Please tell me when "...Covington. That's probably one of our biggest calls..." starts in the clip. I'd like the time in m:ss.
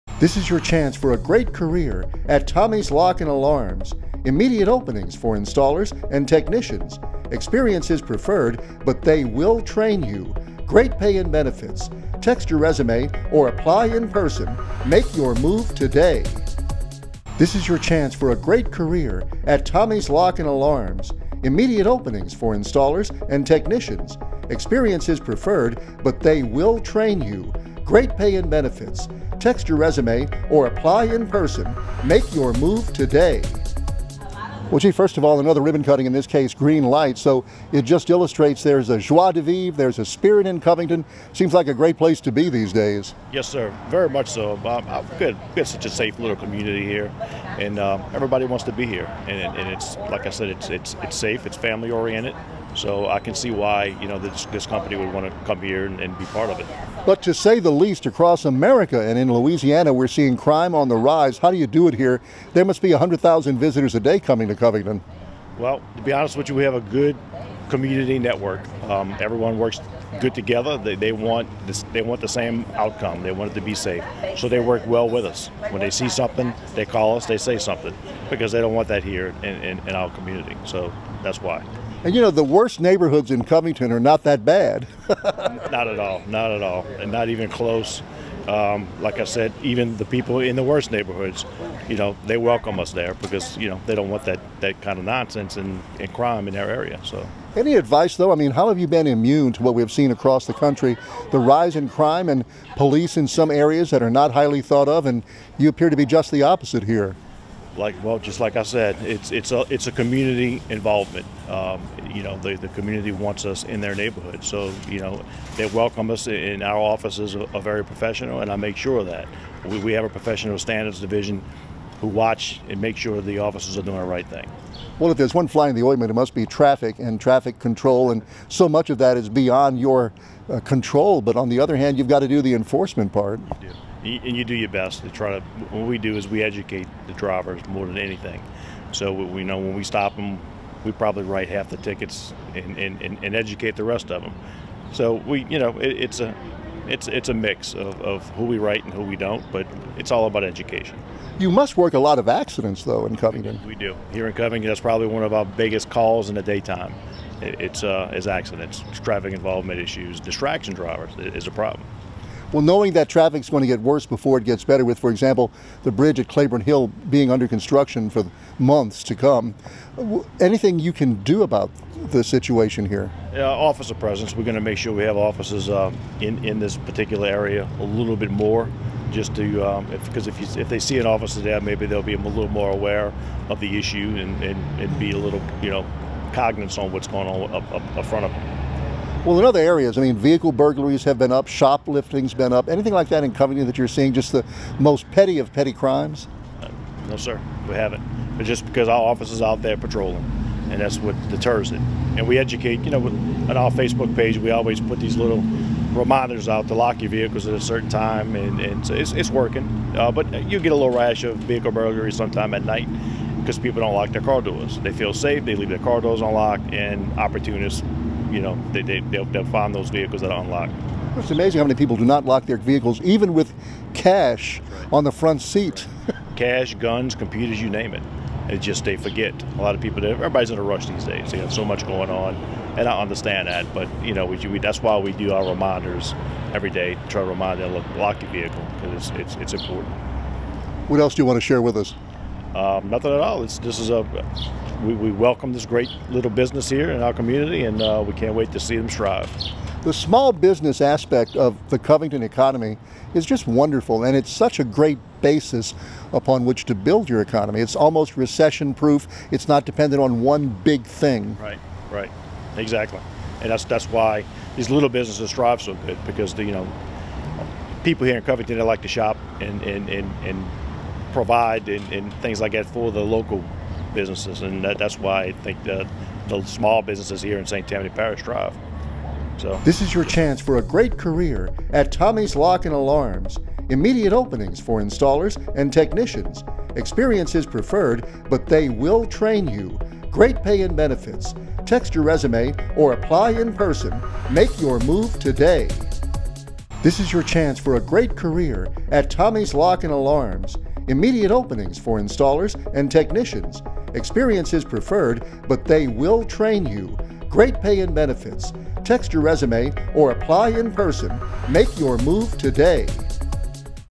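2:34.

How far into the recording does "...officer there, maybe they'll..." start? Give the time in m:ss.
3:01.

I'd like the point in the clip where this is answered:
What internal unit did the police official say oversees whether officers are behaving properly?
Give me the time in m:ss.
2:00.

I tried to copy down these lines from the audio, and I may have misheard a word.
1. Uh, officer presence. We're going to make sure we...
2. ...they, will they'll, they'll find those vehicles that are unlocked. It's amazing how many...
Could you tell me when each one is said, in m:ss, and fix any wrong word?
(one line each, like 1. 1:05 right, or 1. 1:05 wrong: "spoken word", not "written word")
1. 2:53 right
2. 3:38 right.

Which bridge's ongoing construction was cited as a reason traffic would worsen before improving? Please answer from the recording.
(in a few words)
Claiborne Hill.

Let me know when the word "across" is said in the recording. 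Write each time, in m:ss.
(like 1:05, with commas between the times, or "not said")
0:58, 1:40.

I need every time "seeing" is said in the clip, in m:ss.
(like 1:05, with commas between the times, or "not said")
1:00, 3:13.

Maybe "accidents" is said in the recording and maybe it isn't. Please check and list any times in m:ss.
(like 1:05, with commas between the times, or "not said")
2:32, 2:38.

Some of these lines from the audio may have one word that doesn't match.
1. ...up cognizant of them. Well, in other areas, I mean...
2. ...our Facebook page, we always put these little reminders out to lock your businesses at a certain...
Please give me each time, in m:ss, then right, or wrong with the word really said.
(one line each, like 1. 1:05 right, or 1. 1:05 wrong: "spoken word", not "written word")
1. 3:07 wrong: "front", not "cognizant"
2. 3:23 wrong: "vehicles", not "businesses".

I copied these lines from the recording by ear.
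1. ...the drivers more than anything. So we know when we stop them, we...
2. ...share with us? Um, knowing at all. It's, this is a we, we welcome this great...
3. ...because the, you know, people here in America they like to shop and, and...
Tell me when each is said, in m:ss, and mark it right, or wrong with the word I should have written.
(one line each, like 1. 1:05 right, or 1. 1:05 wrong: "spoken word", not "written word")
1. 2:17 right
2. 4:01 wrong: "nothing", not "knowing"
3. 4:26 wrong: "Covington", not "America".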